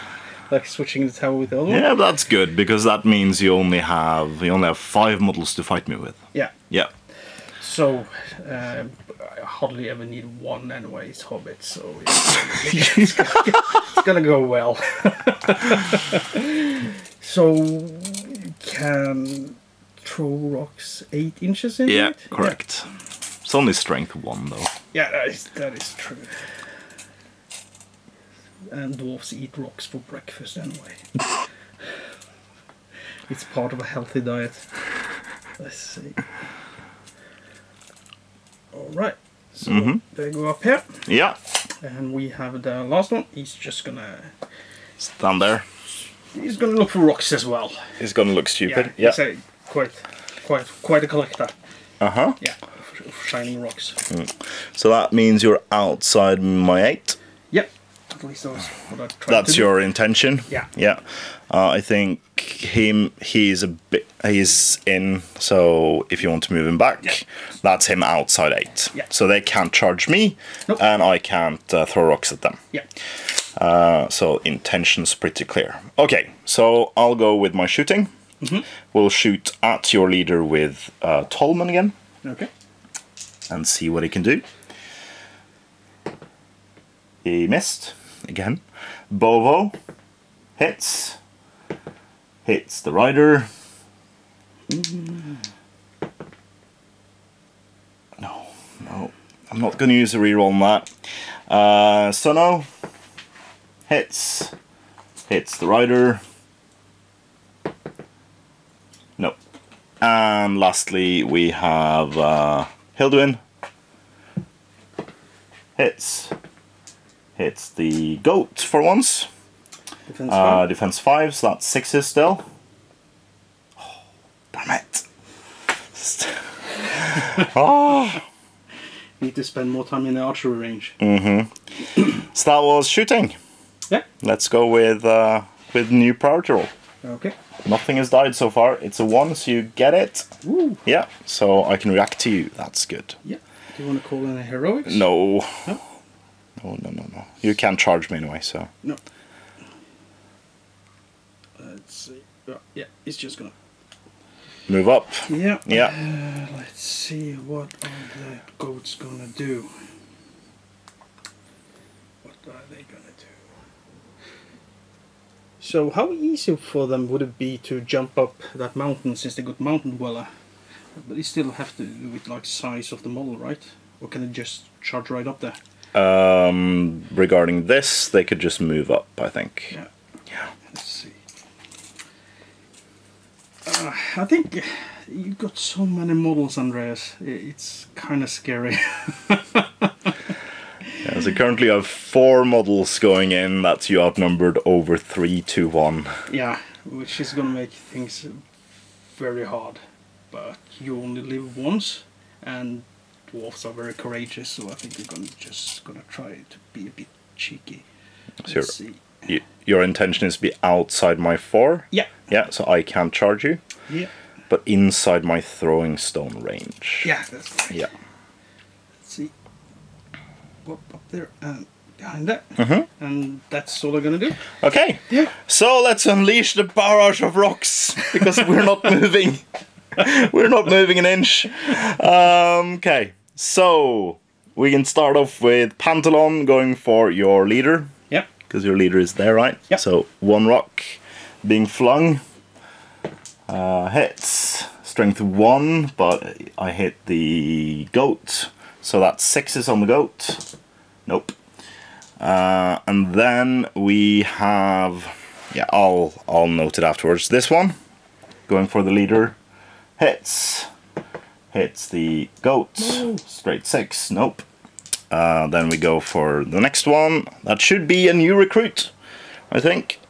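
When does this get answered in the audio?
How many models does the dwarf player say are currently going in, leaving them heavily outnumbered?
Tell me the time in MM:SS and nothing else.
03:11.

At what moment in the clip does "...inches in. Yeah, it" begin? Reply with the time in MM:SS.
00:21.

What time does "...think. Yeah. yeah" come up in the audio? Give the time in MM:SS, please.
02:59.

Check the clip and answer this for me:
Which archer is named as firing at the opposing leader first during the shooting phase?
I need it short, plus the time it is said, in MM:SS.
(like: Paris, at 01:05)
Tolman, at 01:21.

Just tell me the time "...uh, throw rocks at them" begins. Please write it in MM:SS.
01:11.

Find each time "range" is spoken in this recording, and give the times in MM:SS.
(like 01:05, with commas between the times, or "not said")
02:10, 03:36.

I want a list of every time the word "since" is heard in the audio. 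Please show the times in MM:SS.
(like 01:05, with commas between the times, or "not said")
02:49.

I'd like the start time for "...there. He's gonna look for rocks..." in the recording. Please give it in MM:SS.
00:45.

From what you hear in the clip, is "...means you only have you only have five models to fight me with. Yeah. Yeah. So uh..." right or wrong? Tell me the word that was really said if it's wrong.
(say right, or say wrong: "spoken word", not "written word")
right.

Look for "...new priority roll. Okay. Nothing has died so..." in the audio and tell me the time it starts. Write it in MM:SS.
02:15.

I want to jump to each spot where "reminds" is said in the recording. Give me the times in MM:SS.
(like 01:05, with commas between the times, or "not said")
not said.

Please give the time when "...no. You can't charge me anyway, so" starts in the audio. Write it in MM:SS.
02:27.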